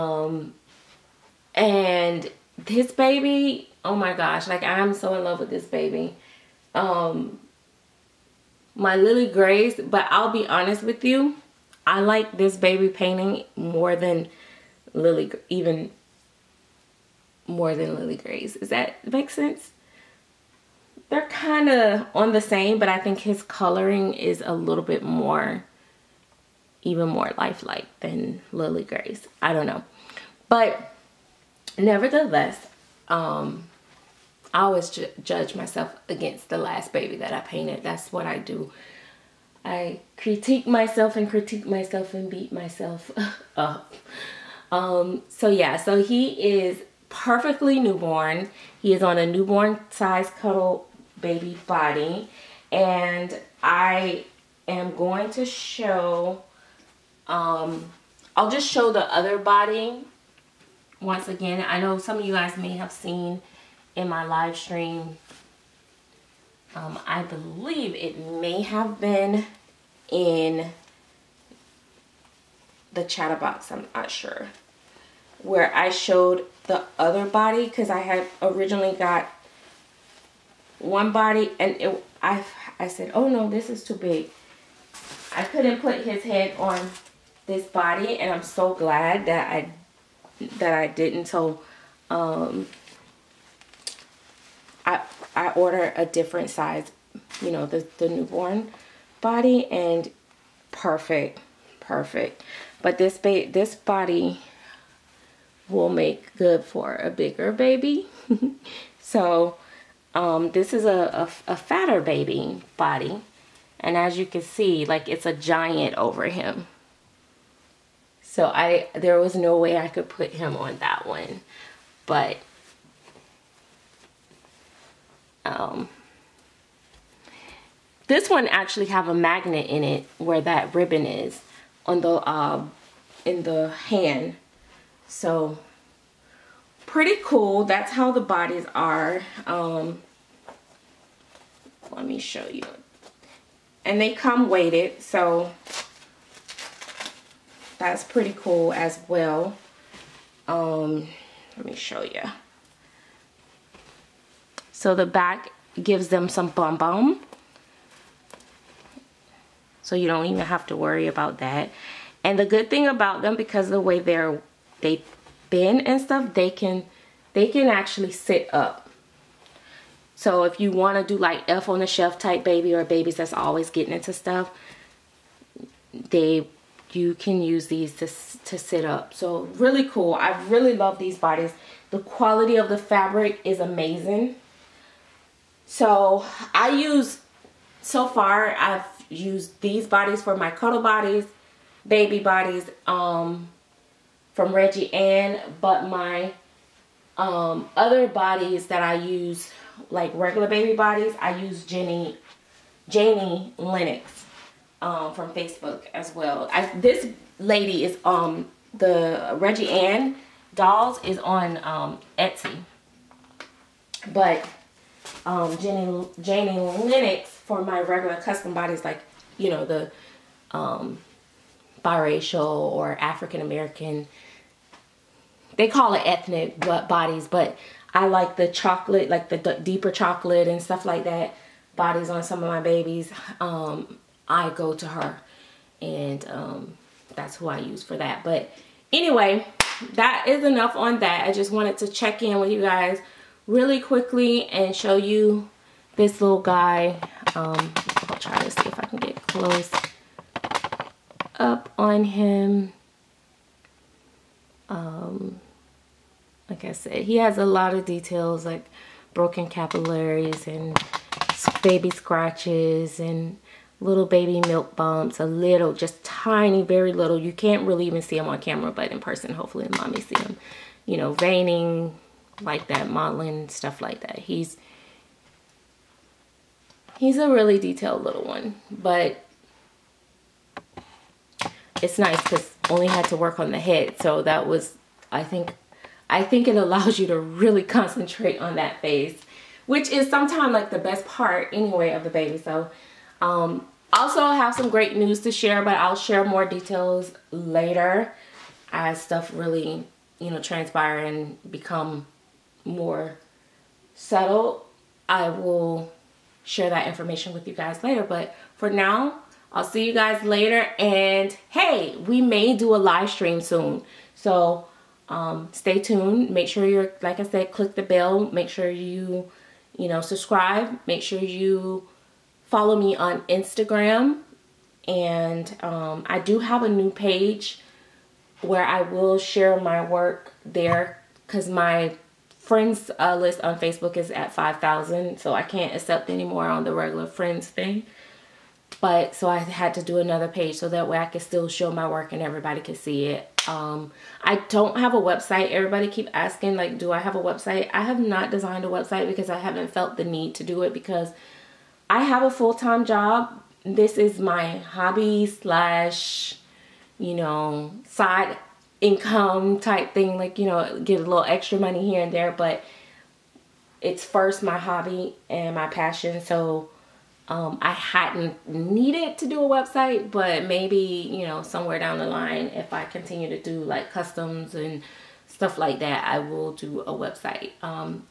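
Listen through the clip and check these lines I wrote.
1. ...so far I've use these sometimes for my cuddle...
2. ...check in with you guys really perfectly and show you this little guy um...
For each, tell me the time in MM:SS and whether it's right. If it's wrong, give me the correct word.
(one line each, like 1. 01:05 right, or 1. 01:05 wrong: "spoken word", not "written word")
1. 03:07 wrong: "bodies", not "sometimes"
2. 04:01 wrong: "quickly", not "perfectly".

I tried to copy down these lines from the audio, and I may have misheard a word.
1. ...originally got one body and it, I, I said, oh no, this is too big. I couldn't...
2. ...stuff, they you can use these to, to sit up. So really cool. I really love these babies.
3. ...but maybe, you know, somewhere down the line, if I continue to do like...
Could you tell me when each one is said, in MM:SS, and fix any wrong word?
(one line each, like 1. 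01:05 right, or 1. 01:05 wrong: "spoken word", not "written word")
1. 01:18 right
2. 02:54 wrong: "bodies", not "babies"
3. 06:10 right.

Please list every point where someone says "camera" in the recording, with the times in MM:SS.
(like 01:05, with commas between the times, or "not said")
04:28.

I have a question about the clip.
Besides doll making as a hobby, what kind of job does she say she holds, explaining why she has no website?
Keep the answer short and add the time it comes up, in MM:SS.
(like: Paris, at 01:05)
Full-time job, at 05:52.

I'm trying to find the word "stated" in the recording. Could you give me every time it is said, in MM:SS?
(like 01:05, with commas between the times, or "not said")
not said.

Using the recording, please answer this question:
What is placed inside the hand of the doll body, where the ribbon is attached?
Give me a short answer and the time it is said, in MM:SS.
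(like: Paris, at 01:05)
A magnet, at 02:09.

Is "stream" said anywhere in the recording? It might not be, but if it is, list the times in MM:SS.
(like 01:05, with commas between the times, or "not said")
01:04, 05:13.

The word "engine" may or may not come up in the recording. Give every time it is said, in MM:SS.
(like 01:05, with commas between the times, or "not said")
not said.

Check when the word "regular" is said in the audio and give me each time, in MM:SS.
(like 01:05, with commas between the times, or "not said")
03:20, 03:37, 05:36.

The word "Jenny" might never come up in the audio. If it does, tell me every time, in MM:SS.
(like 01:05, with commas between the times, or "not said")
03:21, 03:35.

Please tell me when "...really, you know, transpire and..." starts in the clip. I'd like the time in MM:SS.
04:59.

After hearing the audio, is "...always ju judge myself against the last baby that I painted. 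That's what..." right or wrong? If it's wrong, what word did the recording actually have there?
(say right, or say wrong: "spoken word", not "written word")
right.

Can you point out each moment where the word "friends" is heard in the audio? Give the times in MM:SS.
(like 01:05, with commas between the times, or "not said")
05:32, 05:37.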